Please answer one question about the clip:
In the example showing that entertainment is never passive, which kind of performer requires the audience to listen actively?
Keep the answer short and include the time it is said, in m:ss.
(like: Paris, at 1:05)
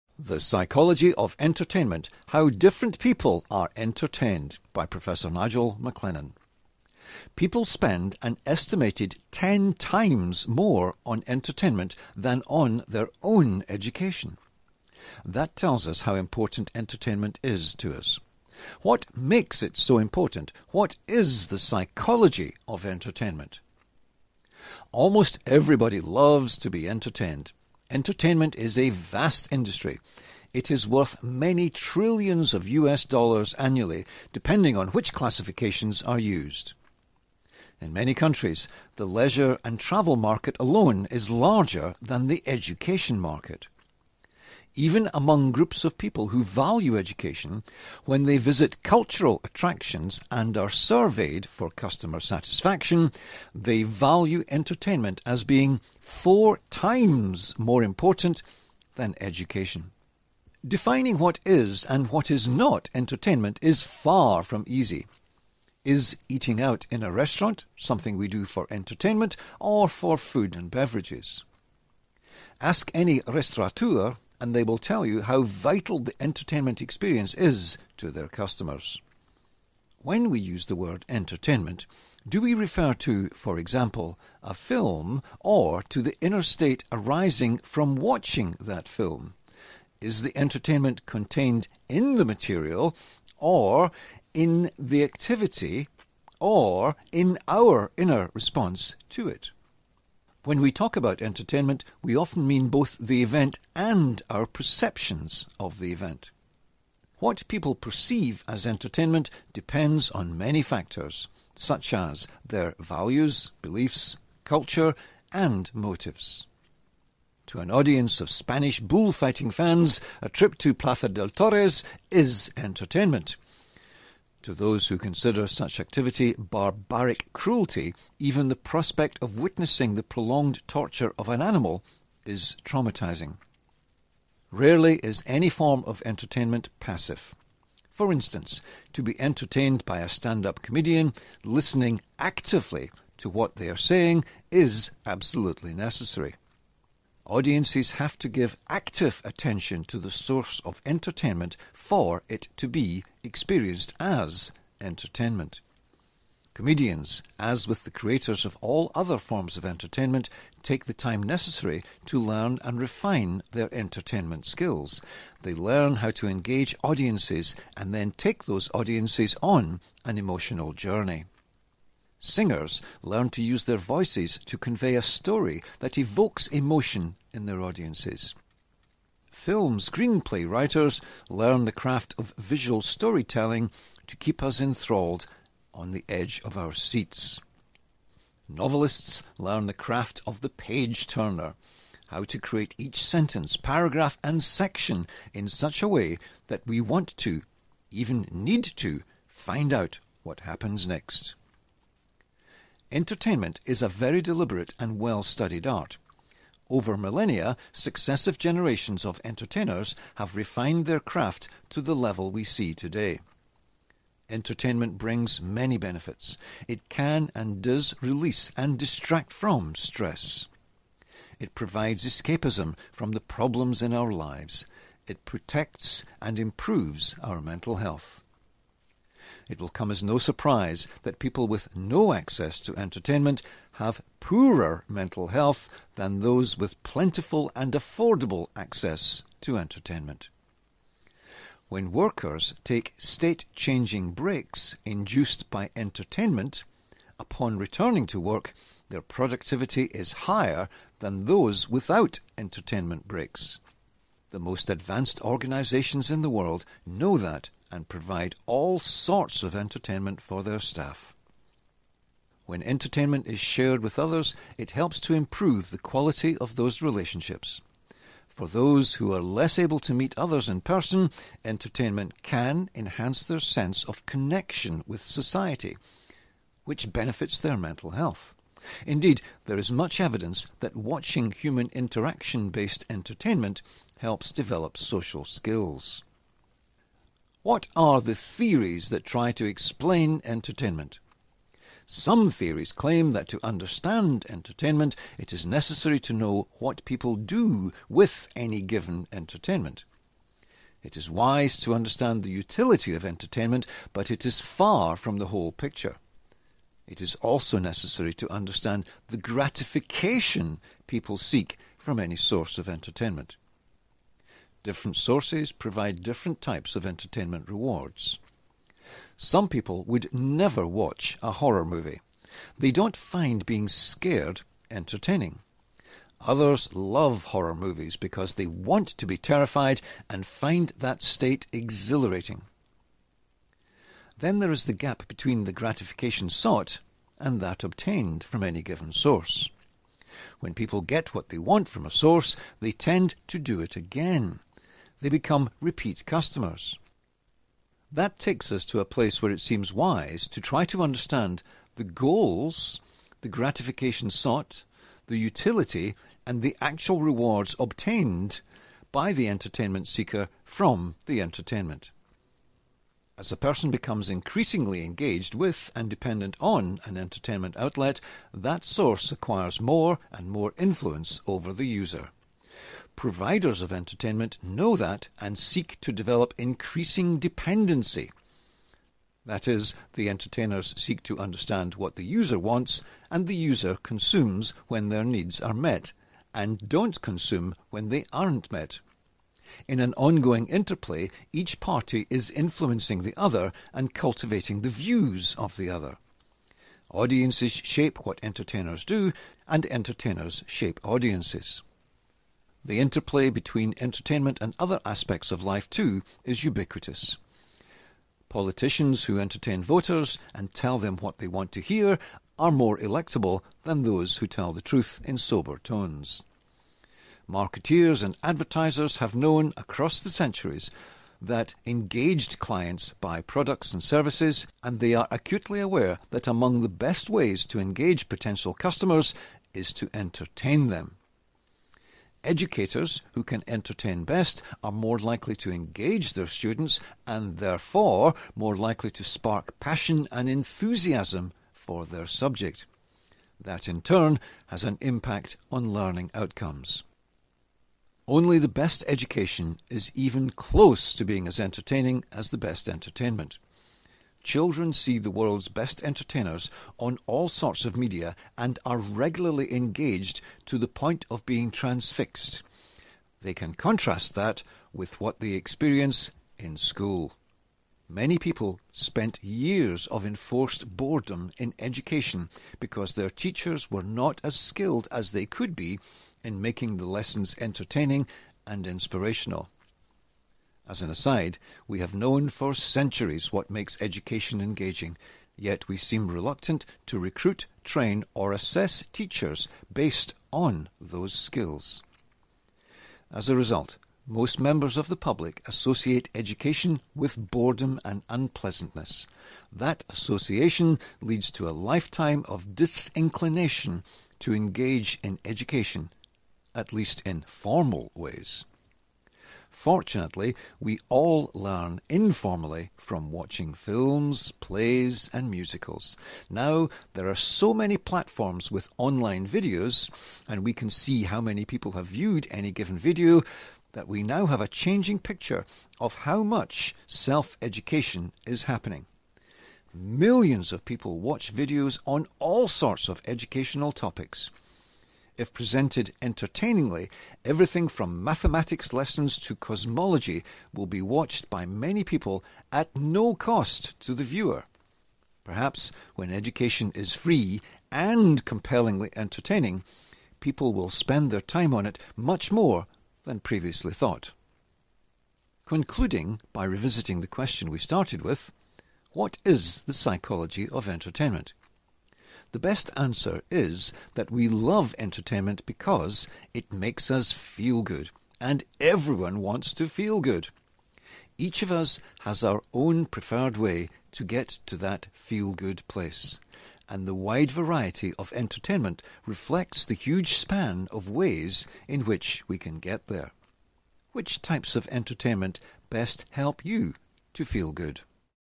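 Stand up comedian, at 2:20.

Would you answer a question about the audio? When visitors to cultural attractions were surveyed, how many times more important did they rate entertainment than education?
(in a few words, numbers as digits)
4 times.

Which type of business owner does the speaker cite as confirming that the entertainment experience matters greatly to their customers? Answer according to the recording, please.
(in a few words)
Restaurateur.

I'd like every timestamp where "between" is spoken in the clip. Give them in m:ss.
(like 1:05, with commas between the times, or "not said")
5:35, 6:43.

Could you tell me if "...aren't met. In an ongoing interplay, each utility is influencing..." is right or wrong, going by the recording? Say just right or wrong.
wrong.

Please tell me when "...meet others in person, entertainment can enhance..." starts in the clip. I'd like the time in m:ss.
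4:29.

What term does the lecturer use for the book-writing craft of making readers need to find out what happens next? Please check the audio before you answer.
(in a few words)
The page turner.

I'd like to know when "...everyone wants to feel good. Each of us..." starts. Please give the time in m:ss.
9:28.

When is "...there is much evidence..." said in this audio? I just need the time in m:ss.
4:39.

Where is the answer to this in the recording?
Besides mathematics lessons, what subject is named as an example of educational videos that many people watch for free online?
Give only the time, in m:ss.
8:59.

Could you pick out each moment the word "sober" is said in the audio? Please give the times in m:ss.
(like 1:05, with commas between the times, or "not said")
6:55.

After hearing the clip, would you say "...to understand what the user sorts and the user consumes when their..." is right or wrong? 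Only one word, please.
wrong.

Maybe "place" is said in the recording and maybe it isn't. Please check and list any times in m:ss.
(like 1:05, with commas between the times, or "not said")
5:48, 9:35.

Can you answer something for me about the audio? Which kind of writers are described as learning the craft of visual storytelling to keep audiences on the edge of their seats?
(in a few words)
Film screenplay writers.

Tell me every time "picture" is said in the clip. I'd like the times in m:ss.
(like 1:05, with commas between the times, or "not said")
5:05, 8:44.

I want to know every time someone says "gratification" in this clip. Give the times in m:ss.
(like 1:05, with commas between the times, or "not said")
5:09, 5:35, 5:53.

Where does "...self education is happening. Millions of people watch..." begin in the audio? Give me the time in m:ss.
8:46.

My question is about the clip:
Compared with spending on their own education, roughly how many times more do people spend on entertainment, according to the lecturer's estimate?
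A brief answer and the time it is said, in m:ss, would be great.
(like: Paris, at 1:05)
10 times, at 0:09.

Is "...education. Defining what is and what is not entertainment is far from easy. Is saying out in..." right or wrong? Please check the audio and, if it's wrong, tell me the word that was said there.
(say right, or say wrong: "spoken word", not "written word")
wrong: "eating", not "saying".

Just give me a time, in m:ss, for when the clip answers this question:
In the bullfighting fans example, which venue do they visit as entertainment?
2:00.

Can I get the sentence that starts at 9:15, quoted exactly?
Concluding by revisiting the question we started with what is the psychology of entertainment?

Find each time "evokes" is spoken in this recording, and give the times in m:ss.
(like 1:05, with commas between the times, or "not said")
2:55.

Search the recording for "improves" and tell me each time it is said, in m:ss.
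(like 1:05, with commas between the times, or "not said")
3:46, 4:25.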